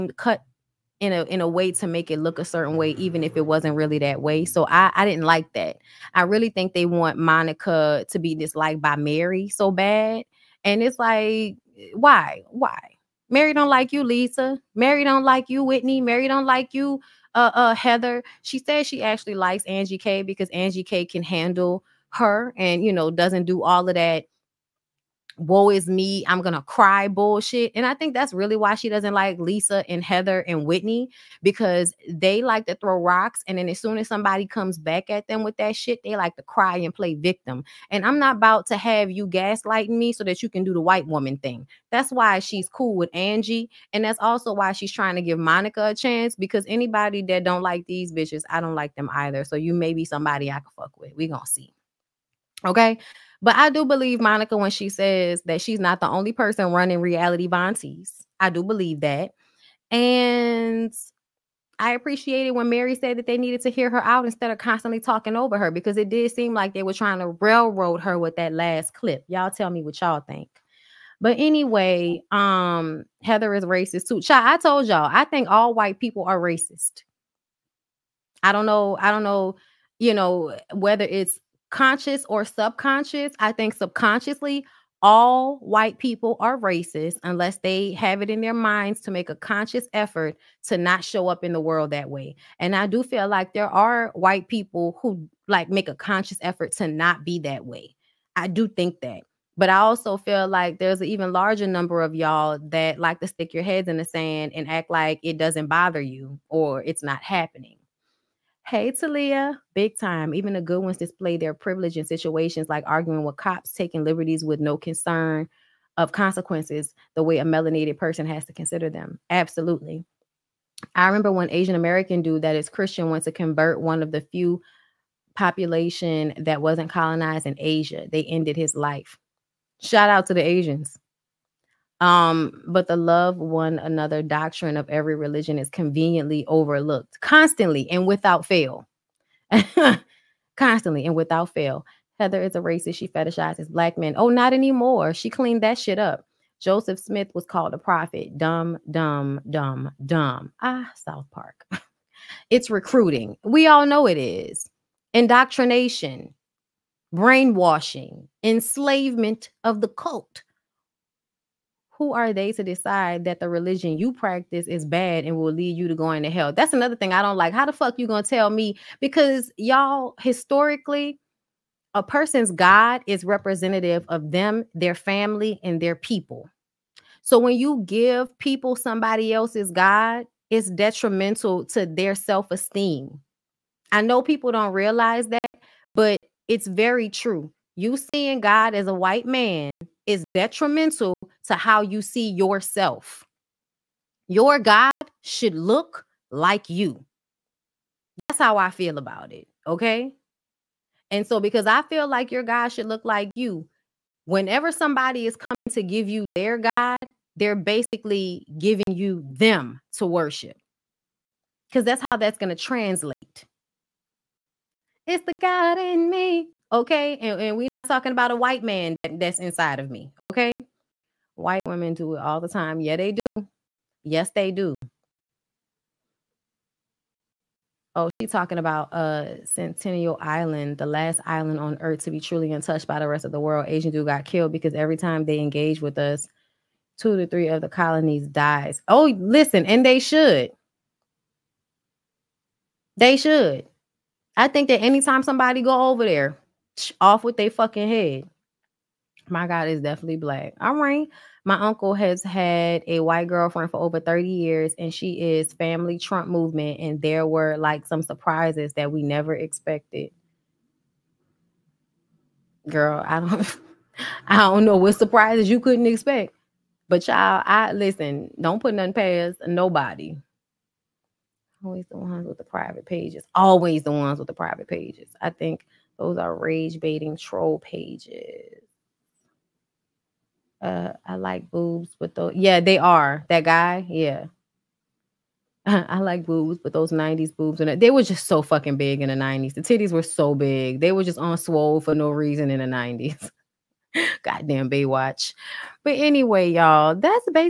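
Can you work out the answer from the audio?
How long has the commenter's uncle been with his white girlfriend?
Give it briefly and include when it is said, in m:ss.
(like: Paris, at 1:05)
over 30 years, at 4:13.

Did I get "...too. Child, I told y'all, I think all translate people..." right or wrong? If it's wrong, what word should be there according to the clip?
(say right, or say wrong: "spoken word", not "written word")
wrong: "white", not "translate".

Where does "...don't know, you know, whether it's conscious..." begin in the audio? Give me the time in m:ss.
1:19.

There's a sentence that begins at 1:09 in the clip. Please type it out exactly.
Y'all tell me what y'all think.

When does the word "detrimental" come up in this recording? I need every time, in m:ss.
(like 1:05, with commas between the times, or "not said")
3:00, 3:10.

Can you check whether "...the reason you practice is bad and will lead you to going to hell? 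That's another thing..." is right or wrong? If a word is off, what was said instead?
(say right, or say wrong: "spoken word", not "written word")
wrong: "religion", not "reason".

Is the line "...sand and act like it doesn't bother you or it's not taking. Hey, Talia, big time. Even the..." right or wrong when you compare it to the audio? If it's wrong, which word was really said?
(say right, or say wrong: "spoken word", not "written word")
wrong: "happening", not "taking".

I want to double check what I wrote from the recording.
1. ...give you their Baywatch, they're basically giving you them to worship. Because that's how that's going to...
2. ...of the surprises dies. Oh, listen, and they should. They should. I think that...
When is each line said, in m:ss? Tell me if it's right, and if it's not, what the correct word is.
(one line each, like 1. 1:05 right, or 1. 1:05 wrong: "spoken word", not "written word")
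1. 3:25 wrong: "God", not "Baywatch"
2. 3:57 wrong: "colonies", not "surprises".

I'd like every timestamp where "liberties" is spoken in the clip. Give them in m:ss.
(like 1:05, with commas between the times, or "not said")
1:54.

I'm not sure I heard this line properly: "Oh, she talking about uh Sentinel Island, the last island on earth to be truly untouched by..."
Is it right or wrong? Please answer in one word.
right.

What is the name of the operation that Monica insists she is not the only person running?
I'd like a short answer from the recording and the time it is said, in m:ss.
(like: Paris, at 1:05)
Reality Von Tease, at 0:56.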